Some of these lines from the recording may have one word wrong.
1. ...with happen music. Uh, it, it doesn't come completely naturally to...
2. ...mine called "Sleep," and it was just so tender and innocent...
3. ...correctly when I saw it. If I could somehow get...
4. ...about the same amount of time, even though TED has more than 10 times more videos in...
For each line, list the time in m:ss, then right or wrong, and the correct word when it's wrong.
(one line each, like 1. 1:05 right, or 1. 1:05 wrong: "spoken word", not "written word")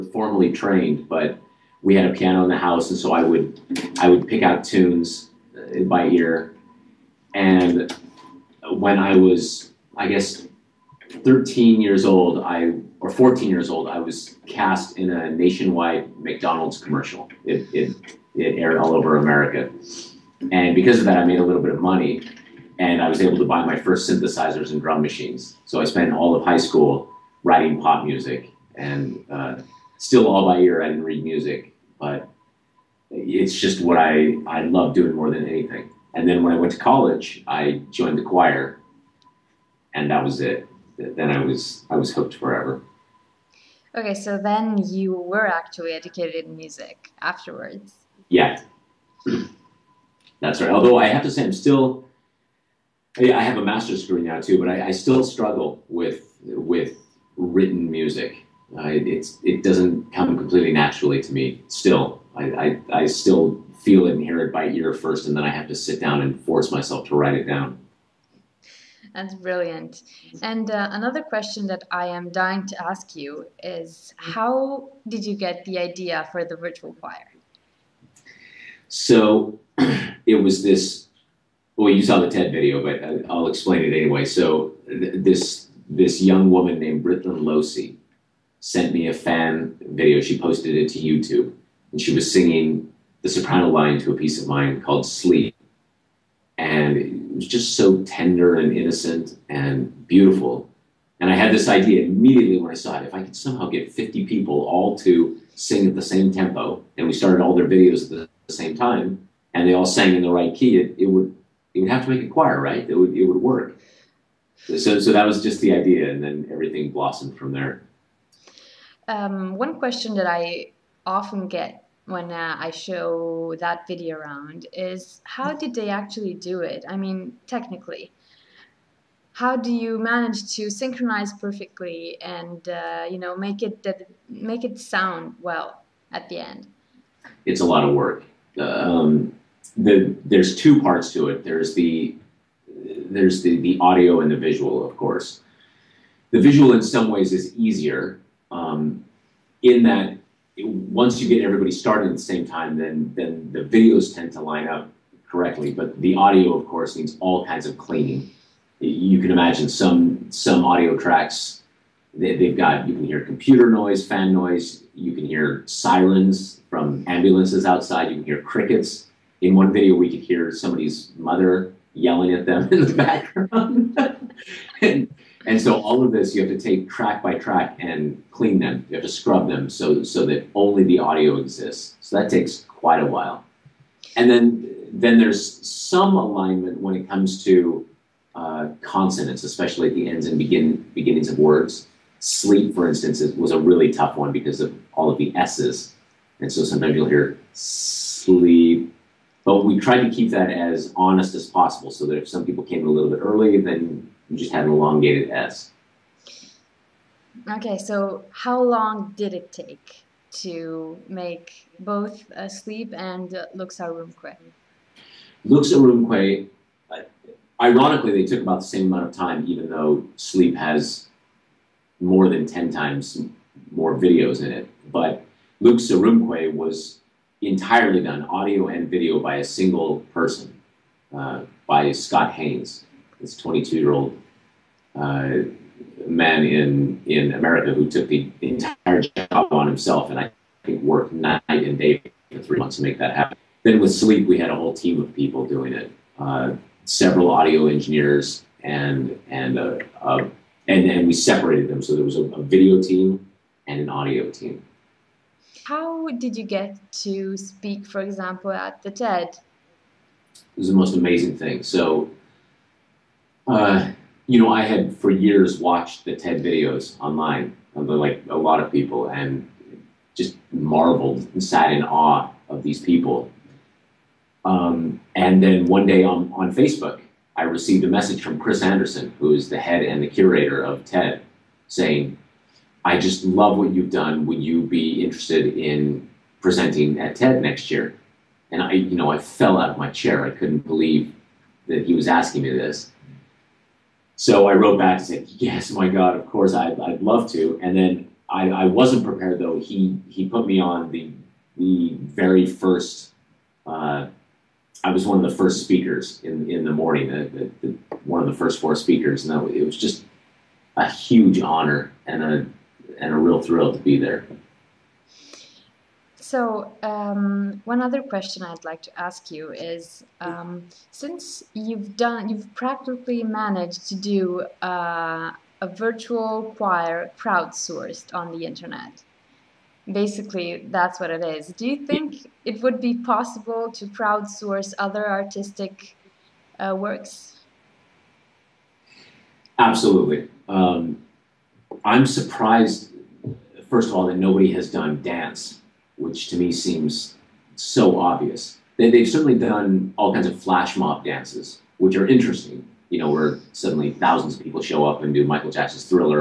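1. 0:56 wrong: "written", not "happen"
2. 1:34 right
3. 1:42 wrong: "immediately", not "correctly"
4. 3:38 wrong: "Sleep", not "TED".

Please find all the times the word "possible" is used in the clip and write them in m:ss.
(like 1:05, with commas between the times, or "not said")
3:21, 5:32.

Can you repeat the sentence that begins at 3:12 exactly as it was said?
Sleep, for instance, is, was a really tough one because of all of the s's, and so sometimes you'll hear sleep.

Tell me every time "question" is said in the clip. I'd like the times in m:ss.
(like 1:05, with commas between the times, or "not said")
1:11, 1:59, 5:18.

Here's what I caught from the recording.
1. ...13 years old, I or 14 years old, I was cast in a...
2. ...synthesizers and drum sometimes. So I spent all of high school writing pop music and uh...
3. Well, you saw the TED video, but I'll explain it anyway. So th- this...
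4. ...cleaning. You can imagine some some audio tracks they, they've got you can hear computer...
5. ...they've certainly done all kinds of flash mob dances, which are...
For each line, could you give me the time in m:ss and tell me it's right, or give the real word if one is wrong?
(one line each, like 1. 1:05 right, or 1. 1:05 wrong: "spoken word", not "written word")
1. 0:11 right
2. 0:24 wrong: "machines", not "sometimes"
3. 1:21 right
4. 2:37 right
5. 5:48 right.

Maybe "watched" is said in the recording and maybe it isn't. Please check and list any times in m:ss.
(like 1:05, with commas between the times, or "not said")
4:25.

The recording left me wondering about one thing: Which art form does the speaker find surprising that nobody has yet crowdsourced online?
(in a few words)
Dance.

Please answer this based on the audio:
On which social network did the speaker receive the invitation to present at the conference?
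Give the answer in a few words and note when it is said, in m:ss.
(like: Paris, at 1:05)
Facebook, at 4:36.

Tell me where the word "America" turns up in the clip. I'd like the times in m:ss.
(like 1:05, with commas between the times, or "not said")
0:19, 3:57.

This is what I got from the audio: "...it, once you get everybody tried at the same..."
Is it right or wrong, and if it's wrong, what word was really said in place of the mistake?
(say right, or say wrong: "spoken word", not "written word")
wrong: "started", not "tried".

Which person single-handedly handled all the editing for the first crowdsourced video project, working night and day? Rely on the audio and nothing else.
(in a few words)
Scott Haines.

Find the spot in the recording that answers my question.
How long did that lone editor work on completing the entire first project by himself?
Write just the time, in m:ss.
4:02.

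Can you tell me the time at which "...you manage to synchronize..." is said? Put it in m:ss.
2:09.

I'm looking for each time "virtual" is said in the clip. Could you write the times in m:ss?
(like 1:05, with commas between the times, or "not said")
1:16, 5:25.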